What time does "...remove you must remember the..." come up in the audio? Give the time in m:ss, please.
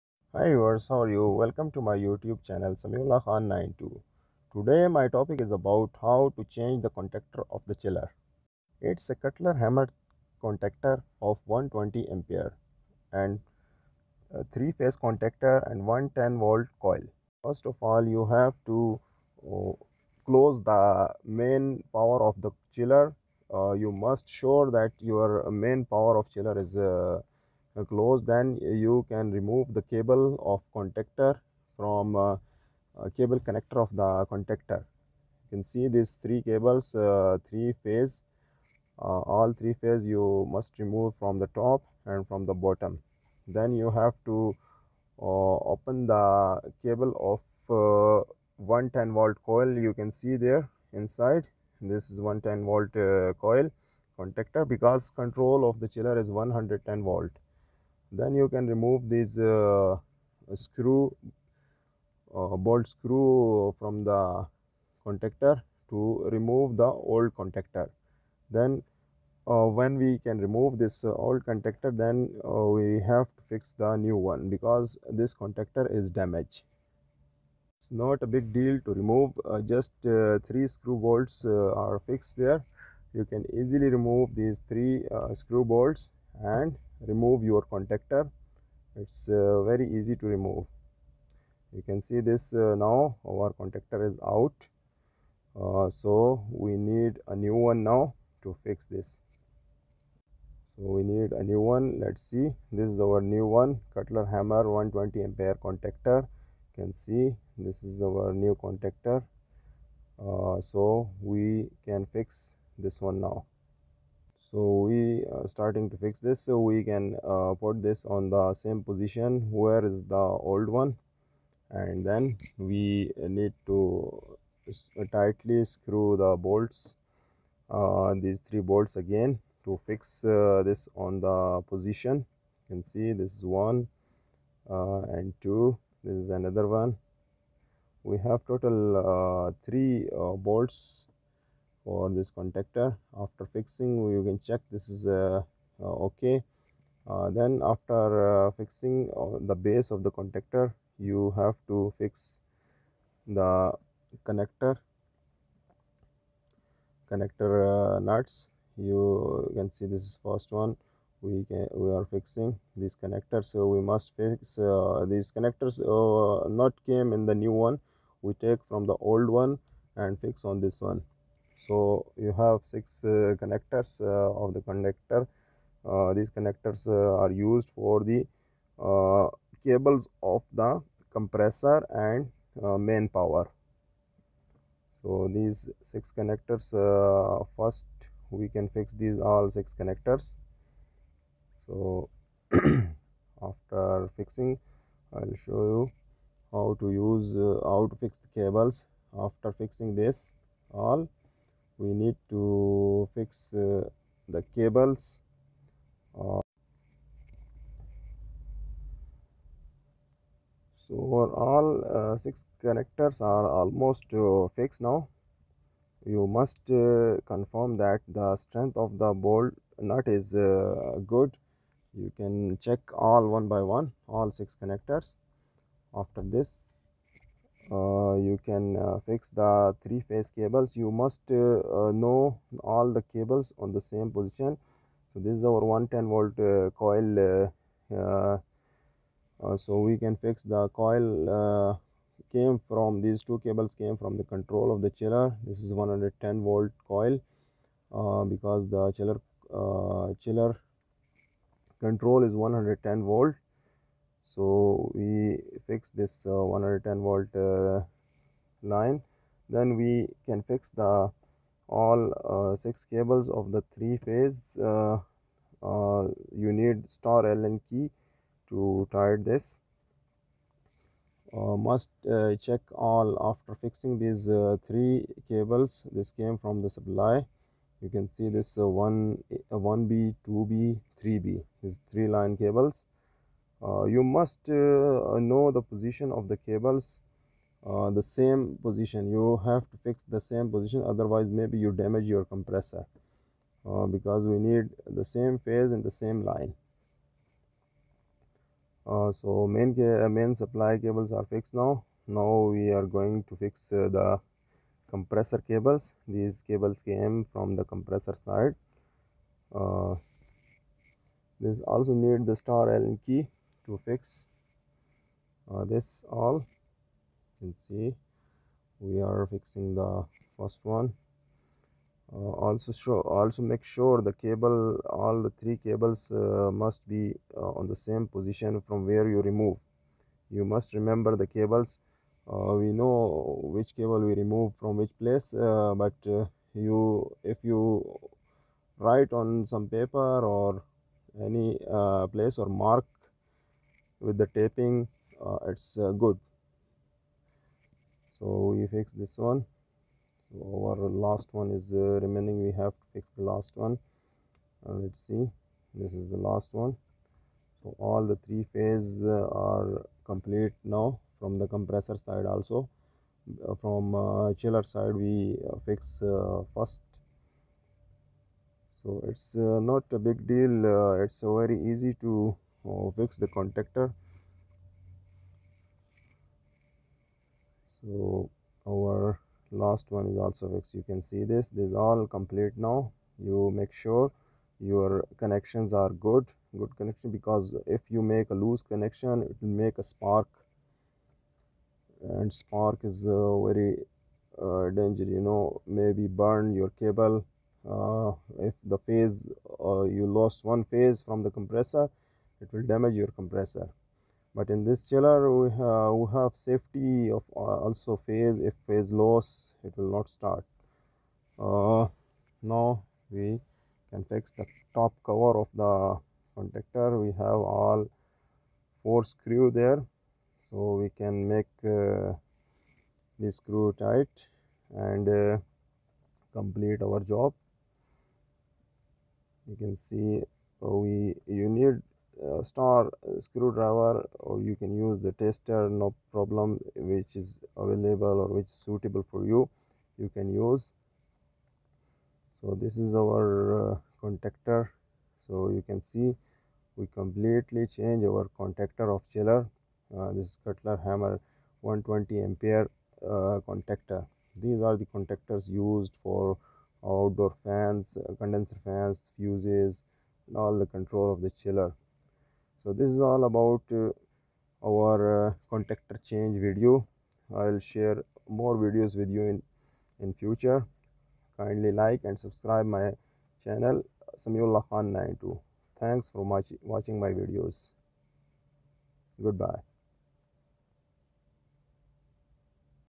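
5:29.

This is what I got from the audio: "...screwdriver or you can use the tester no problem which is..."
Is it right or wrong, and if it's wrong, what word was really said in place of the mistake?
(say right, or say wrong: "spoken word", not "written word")
right.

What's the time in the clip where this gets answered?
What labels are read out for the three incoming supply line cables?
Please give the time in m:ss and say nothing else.
4:39.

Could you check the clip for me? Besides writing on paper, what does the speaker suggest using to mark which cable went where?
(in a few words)
Taping.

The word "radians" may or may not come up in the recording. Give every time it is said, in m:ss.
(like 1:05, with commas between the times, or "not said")
not said.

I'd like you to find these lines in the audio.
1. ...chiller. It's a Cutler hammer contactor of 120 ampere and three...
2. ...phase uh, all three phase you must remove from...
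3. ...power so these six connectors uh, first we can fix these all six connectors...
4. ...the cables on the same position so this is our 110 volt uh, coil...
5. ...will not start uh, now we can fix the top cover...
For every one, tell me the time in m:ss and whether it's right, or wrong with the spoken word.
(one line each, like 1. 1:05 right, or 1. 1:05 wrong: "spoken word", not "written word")
1. 0:07 right
2. 0:37 right
3. 3:03 right
4. 3:52 right
5. 6:49 right.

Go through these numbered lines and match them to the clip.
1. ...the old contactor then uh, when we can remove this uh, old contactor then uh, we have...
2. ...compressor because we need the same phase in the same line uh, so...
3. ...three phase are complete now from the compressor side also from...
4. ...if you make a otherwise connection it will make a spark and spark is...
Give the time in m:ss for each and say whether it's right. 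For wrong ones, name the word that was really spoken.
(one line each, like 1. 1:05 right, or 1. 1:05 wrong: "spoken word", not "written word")
1. 1:06 right
2. 4:52 right
3. 5:58 right
4. 6:27 wrong: "loose", not "otherwise".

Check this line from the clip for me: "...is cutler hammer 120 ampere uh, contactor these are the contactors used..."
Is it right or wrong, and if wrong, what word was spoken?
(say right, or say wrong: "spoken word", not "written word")
right.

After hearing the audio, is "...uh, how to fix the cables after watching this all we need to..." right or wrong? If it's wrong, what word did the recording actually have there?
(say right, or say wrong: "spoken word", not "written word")
wrong: "fixing", not "watching".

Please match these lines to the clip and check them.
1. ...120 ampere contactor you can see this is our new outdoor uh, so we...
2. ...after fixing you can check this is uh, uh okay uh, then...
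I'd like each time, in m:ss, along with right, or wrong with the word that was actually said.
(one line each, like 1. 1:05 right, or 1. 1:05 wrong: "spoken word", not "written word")
1. 1:44 wrong: "contactor", not "outdoor"
2. 2:23 right.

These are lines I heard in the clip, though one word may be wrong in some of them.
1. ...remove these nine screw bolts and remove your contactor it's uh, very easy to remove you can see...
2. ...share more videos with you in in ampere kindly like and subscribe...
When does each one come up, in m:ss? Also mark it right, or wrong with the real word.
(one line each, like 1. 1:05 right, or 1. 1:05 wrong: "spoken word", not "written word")
1. 1:23 wrong: "three", not "nine"
2. 7:47 wrong: "future", not "ampere".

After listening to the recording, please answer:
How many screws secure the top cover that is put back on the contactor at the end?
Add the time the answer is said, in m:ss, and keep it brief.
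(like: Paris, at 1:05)
4, at 6:58.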